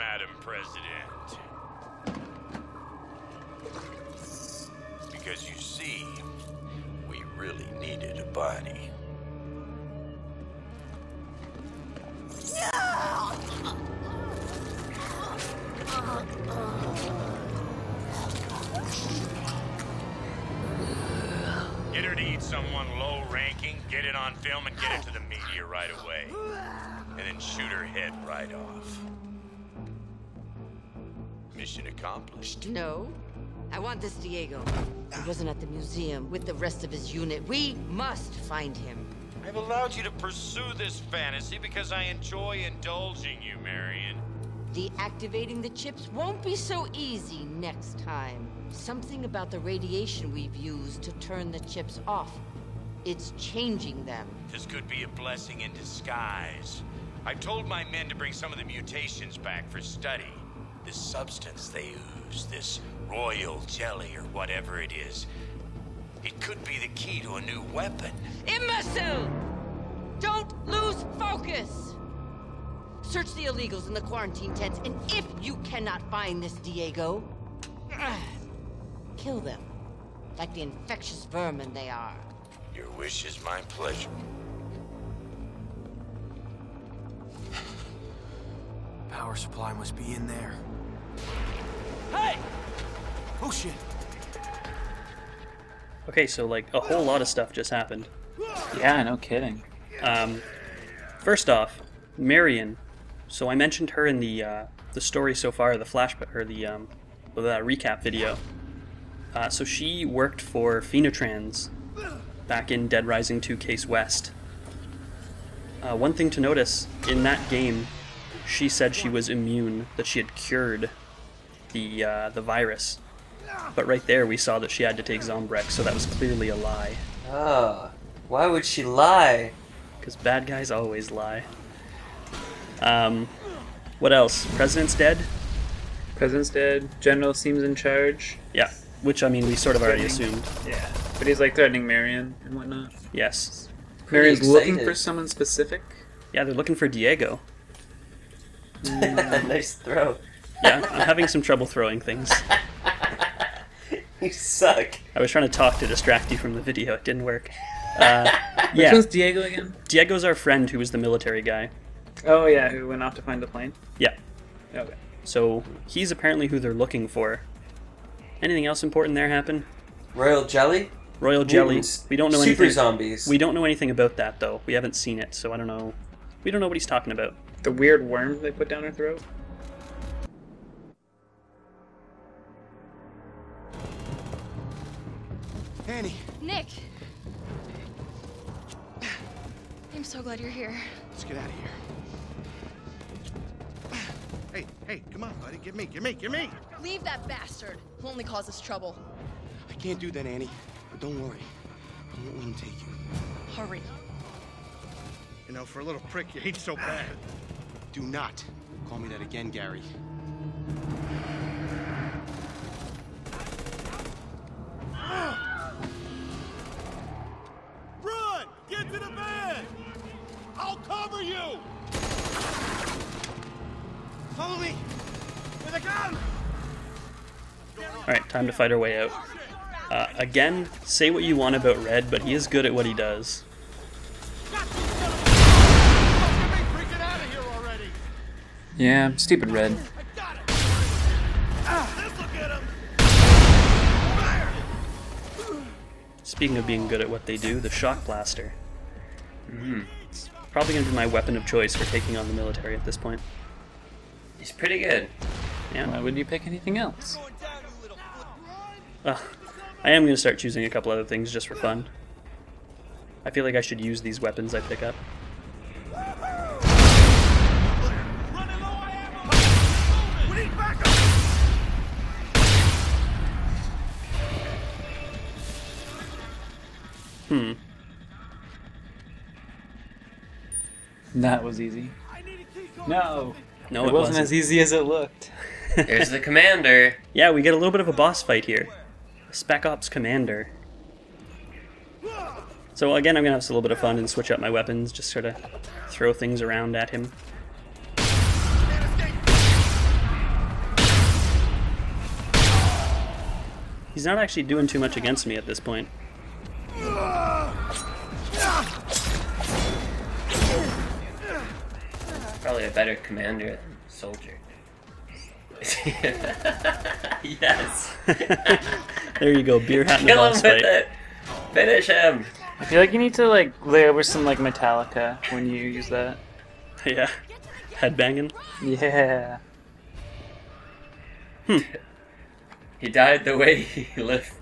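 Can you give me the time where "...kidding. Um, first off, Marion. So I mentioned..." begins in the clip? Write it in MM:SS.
01:39.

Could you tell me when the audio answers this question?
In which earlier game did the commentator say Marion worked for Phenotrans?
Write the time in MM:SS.
01:52.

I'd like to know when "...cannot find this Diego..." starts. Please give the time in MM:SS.
01:15.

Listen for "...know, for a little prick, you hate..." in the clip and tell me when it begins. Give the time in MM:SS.
03:25.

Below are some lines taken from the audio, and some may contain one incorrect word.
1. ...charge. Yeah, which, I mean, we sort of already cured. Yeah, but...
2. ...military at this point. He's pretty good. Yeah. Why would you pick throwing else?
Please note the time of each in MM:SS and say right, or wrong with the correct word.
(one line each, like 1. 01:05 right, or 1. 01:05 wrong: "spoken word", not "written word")
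1. 02:17 wrong: "assumed", not "cured"
2. 04:12 wrong: "anything", not "throwing".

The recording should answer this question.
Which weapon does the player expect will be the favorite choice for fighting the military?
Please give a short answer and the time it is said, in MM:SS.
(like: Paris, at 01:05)
Shock Blaster, at 04:07.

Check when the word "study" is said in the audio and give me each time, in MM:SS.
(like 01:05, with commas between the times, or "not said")
00:59.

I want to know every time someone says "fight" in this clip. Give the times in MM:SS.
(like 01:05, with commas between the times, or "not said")
03:48, 04:48, 05:20.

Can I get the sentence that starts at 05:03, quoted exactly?
He's not actually doing too much against me at this point.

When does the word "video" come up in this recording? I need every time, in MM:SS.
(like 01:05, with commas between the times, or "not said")
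01:48, 02:36.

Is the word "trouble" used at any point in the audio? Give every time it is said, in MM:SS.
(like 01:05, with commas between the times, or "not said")
02:31, 03:18.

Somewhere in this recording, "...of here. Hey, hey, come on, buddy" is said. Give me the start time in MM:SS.
03:11.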